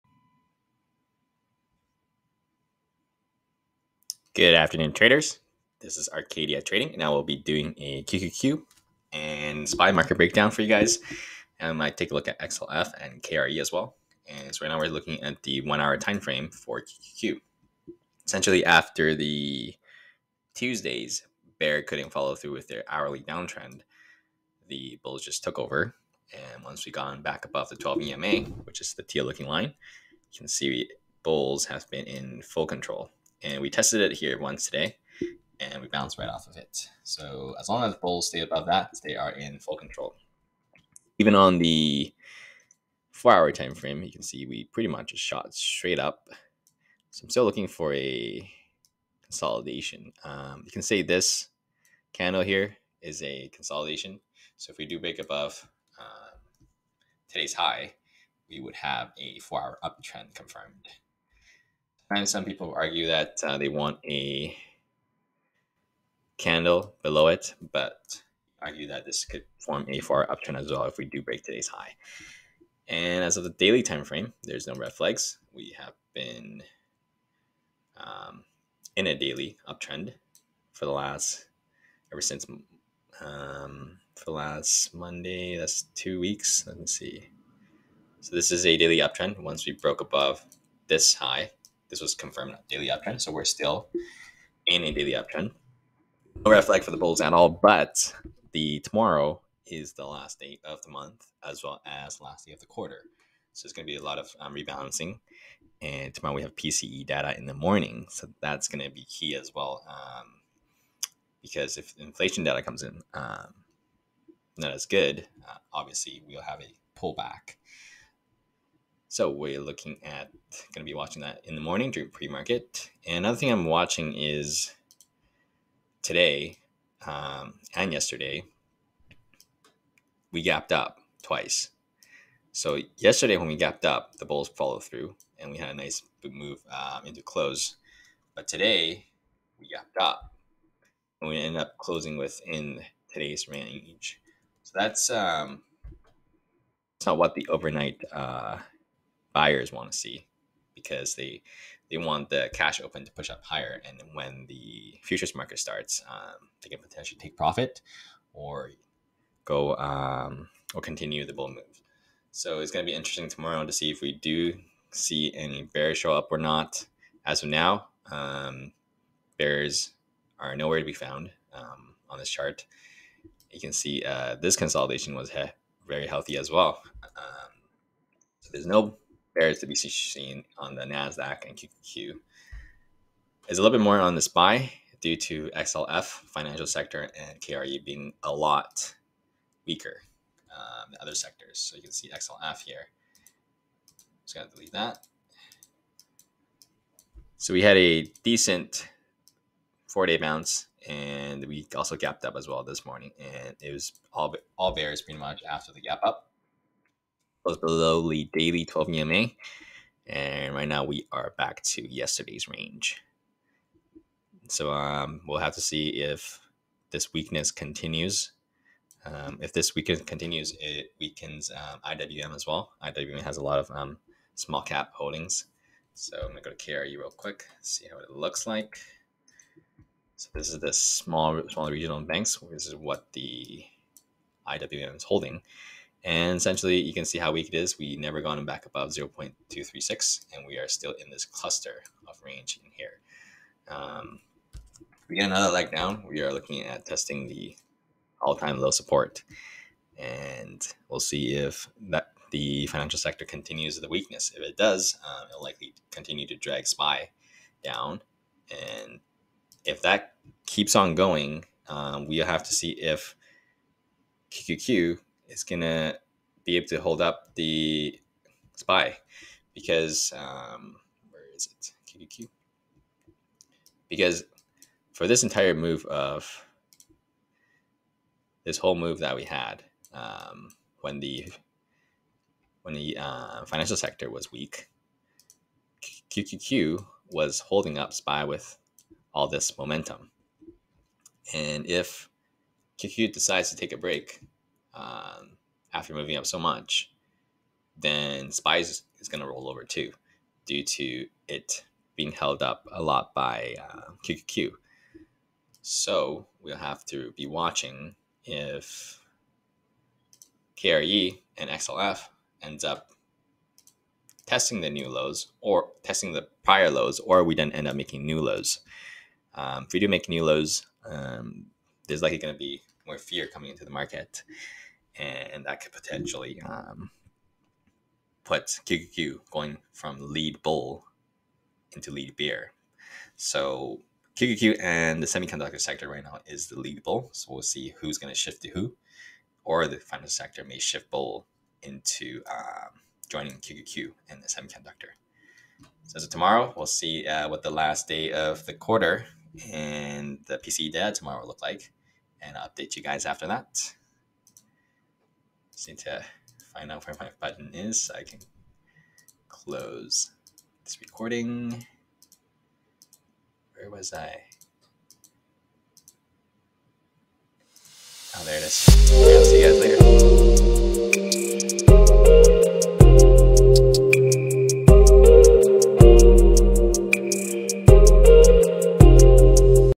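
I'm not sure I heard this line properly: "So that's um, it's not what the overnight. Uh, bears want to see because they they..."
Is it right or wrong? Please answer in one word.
wrong.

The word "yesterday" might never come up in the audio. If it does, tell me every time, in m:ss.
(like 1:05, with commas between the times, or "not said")
2:07, 2:12, 3:31.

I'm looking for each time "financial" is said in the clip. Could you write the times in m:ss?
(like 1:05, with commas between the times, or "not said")
3:06, 4:12, 4:43, 5:39.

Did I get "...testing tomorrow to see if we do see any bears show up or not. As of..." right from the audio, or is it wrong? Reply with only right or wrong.
wrong.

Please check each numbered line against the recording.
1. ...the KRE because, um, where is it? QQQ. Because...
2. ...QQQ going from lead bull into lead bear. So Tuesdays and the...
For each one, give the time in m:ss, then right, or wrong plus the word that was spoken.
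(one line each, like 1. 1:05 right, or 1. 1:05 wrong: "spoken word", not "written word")
1. 4:27 wrong: "SPY", not "KRE"
2. 5:28 wrong: "QQQ", not "Tuesdays".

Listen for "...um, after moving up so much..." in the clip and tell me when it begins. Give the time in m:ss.
4:54.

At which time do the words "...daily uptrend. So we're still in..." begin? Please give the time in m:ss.
1:32.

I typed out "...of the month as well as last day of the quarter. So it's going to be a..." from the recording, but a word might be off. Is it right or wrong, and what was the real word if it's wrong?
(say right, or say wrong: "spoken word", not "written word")
right.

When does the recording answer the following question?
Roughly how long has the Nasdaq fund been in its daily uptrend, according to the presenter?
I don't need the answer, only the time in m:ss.
1:25.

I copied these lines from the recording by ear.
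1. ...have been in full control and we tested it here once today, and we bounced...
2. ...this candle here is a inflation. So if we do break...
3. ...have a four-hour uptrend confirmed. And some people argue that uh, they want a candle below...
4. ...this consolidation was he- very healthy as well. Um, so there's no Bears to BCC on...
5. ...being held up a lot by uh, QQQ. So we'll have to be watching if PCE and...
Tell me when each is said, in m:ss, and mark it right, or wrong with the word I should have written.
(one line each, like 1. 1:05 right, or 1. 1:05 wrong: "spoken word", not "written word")
1. 0:31 right
2. 0:51 wrong: "consolidation", not "inflation"
3. 0:58 right
4. 2:54 right
5. 5:01 wrong: "KRE", not "PCE".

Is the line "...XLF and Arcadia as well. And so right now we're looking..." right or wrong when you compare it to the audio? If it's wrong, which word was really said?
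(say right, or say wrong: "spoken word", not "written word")
wrong: "KRE", not "Arcadia".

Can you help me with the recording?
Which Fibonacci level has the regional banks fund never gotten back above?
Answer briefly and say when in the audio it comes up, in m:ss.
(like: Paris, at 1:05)
0.236, at 3:58.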